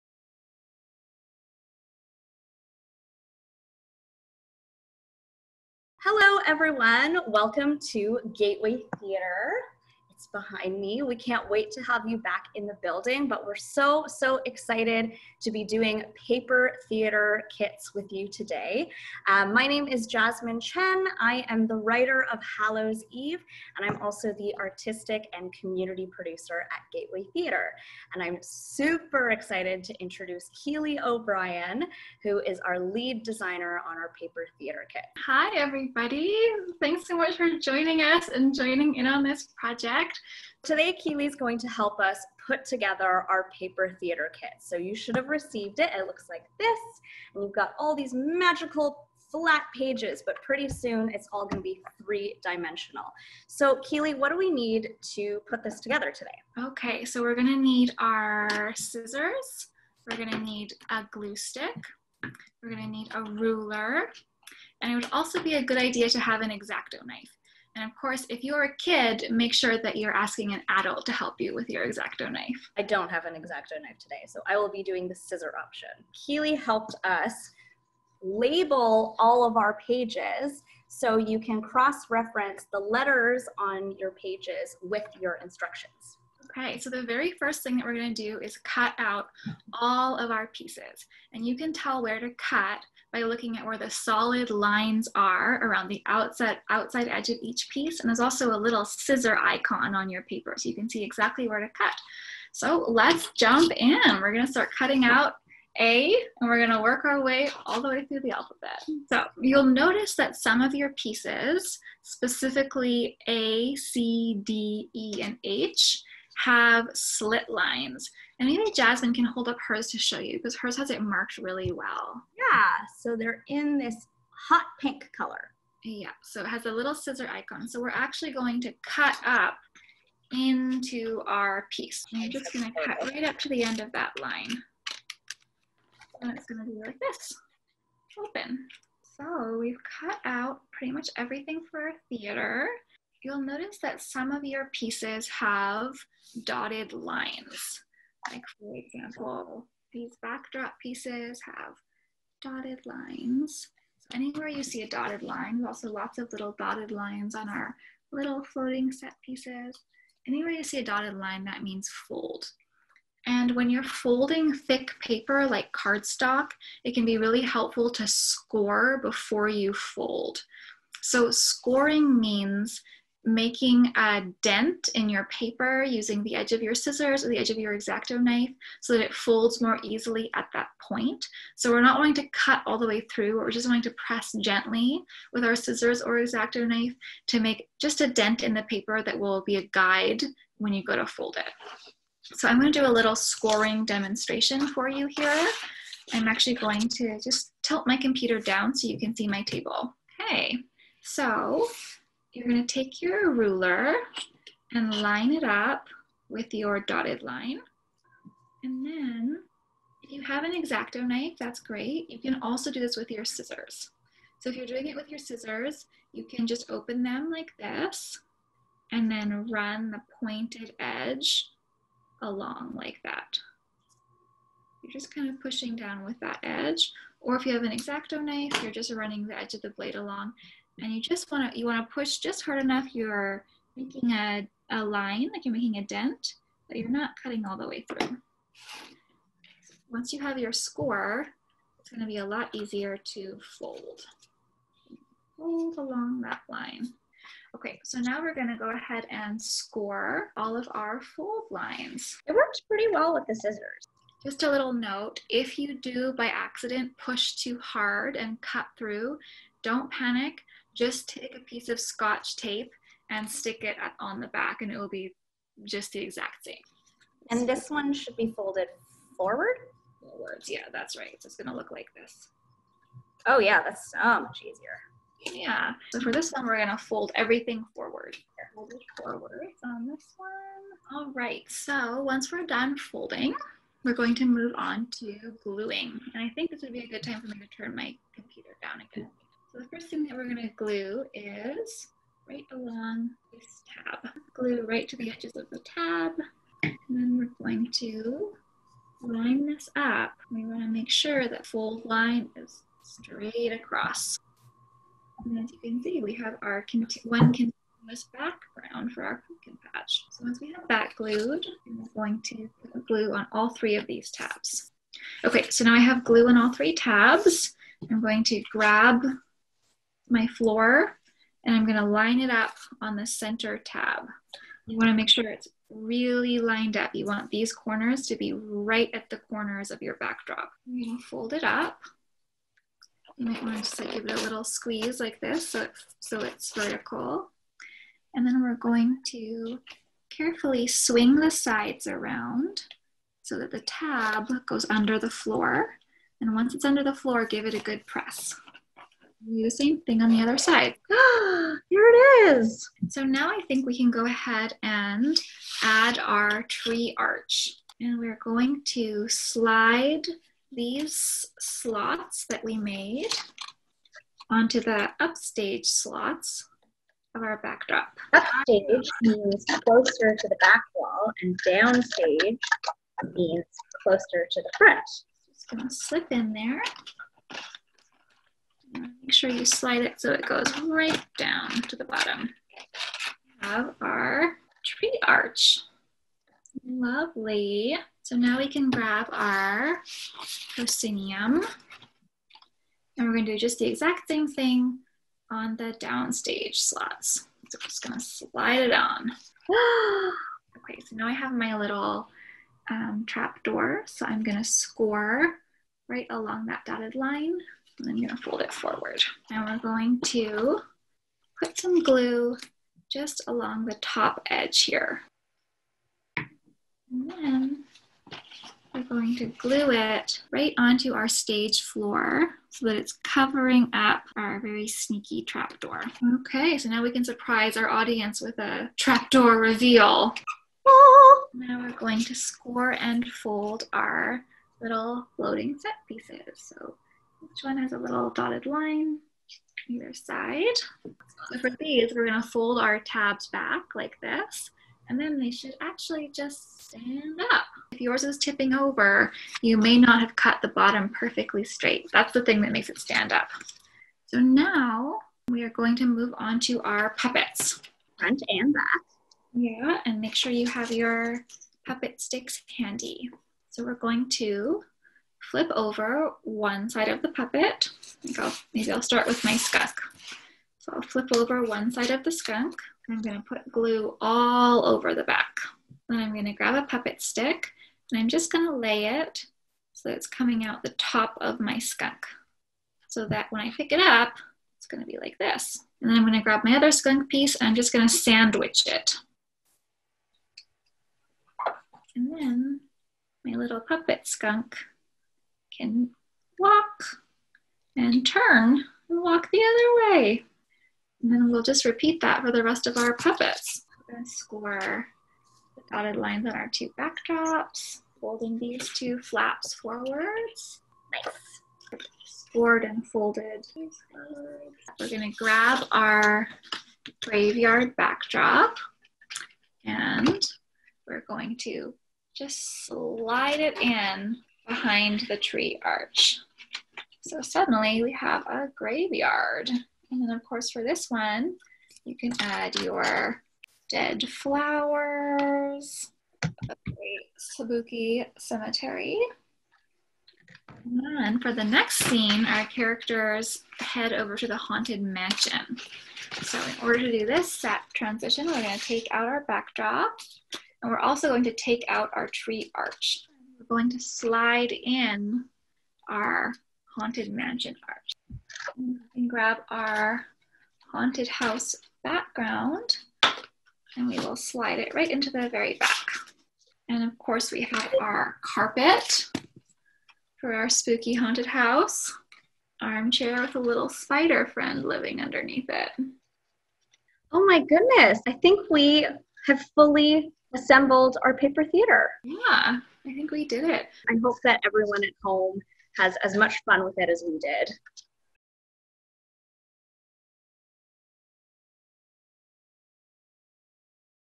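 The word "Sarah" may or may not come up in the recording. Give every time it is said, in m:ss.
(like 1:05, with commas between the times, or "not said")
not said.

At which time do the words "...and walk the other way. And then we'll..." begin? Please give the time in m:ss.
8:18.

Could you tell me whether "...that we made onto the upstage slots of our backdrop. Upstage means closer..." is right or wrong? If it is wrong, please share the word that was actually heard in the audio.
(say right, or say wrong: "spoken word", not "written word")
right.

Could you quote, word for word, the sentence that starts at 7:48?
I'll, maybe I'll start with my skunk.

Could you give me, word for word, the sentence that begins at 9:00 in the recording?
And for the next scene, our characters head over to the haunted mansion.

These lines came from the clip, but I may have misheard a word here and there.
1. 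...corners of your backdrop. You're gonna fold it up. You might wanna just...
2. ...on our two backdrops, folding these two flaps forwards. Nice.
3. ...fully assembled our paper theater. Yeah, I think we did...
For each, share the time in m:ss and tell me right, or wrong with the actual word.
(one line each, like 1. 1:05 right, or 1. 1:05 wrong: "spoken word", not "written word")
1. 5:29 right
2. 8:26 right
3. 9:39 right.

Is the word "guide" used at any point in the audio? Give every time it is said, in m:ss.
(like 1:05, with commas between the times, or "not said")
3:09.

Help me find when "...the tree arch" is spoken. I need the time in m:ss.
8:45.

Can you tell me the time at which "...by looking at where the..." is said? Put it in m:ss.
1:33.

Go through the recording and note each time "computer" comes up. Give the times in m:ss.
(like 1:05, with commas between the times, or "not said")
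3:17, 4:48.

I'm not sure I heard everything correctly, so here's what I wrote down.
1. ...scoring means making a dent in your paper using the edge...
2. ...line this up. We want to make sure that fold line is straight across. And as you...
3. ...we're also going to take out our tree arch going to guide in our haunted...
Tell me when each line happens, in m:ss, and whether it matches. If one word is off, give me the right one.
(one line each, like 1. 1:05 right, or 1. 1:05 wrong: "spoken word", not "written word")
1. 2:51 right
2. 4:59 right
3. 9:10 wrong: "slide", not "guide".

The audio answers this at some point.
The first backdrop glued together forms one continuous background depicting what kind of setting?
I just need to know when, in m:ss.
5:09.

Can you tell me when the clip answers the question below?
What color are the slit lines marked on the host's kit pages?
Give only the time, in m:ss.
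2:04.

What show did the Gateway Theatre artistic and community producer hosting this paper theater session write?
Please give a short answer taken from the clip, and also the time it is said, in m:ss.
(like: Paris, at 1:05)
Hallows Eve, at 0:22.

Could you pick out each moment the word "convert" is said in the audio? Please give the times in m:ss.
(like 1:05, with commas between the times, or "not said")
not said.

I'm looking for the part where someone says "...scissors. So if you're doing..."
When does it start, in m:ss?
3:33.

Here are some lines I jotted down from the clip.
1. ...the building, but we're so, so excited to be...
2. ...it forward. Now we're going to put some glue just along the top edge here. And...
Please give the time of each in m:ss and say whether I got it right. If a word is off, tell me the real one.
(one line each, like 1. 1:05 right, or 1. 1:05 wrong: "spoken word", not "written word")
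1. 0:12 right
2. 6:48 right.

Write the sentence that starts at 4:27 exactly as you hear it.
And this one should be folded forward?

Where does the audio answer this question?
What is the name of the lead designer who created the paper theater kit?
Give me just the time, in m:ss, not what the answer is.
0:30.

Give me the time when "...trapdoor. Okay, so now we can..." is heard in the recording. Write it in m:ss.
7:05.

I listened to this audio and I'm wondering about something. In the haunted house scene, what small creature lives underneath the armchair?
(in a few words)
spider.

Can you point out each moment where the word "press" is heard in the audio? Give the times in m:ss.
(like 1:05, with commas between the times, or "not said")
3:04, 5:47.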